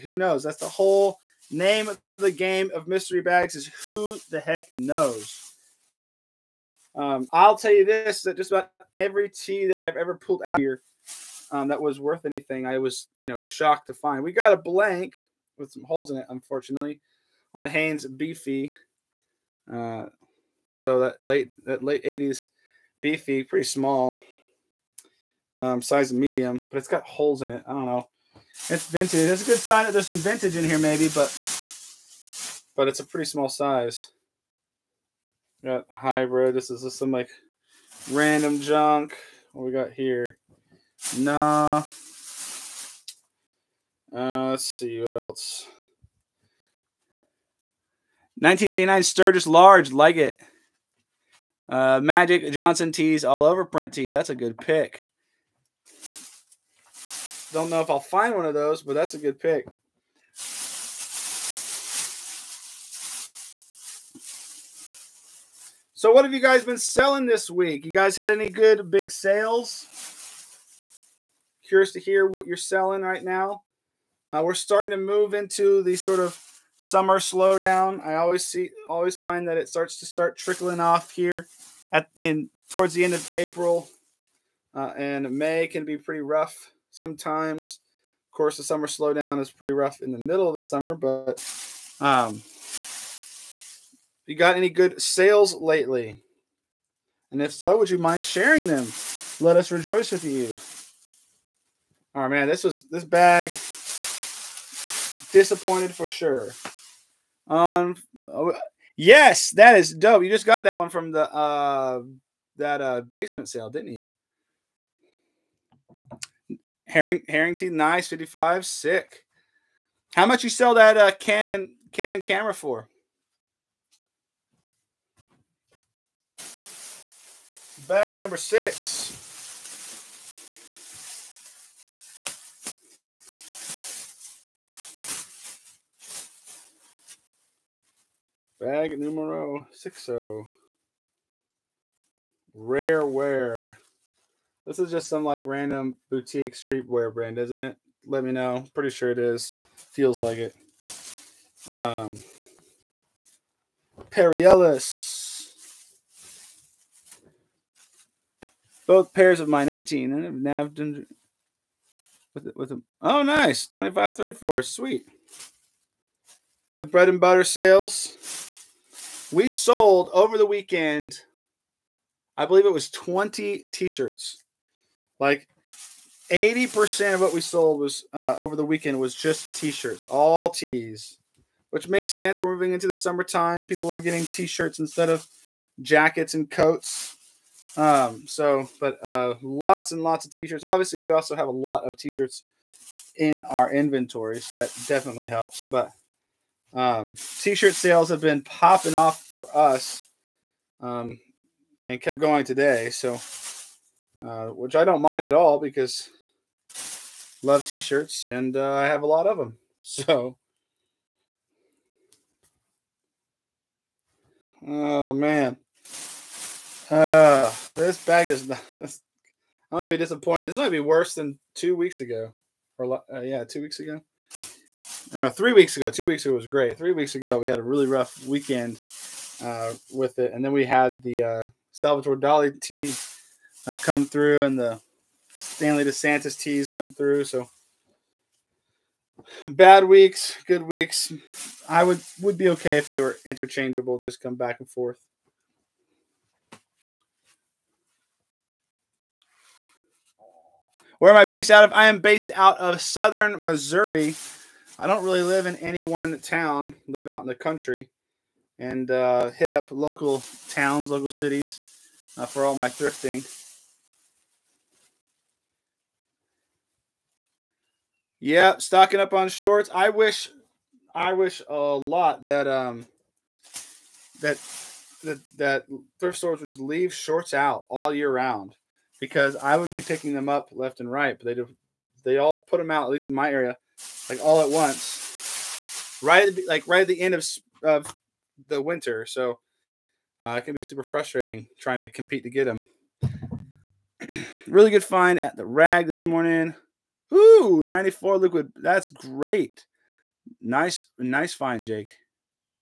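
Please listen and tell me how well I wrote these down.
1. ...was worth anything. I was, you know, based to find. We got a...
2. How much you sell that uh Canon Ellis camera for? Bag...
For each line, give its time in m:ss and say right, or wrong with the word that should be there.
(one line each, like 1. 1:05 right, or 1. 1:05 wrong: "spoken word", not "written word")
1. 0:11 wrong: "shocked", not "based"
2. 2:00 wrong: "Canon", not "Ellis".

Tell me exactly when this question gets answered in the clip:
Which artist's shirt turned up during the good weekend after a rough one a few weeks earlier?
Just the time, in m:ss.
3:51.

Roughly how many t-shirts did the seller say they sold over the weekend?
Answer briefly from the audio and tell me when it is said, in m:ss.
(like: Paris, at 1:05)
20, at 2:52.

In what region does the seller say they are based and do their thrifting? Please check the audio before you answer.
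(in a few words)
Southern Missouri.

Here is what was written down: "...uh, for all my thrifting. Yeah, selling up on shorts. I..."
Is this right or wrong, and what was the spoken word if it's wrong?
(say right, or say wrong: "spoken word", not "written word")
wrong: "stocking", not "selling".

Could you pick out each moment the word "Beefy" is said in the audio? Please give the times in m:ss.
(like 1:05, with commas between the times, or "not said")
0:18, 0:22.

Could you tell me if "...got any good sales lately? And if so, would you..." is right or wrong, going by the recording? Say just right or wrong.
right.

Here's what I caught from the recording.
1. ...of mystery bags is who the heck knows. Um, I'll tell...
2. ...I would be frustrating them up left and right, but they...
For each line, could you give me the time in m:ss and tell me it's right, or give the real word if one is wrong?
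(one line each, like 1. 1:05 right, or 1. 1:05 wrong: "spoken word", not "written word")
1. 0:02 right
2. 4:39 wrong: "picking", not "frustrating".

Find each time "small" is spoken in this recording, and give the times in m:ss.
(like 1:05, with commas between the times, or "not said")
0:23, 0:33.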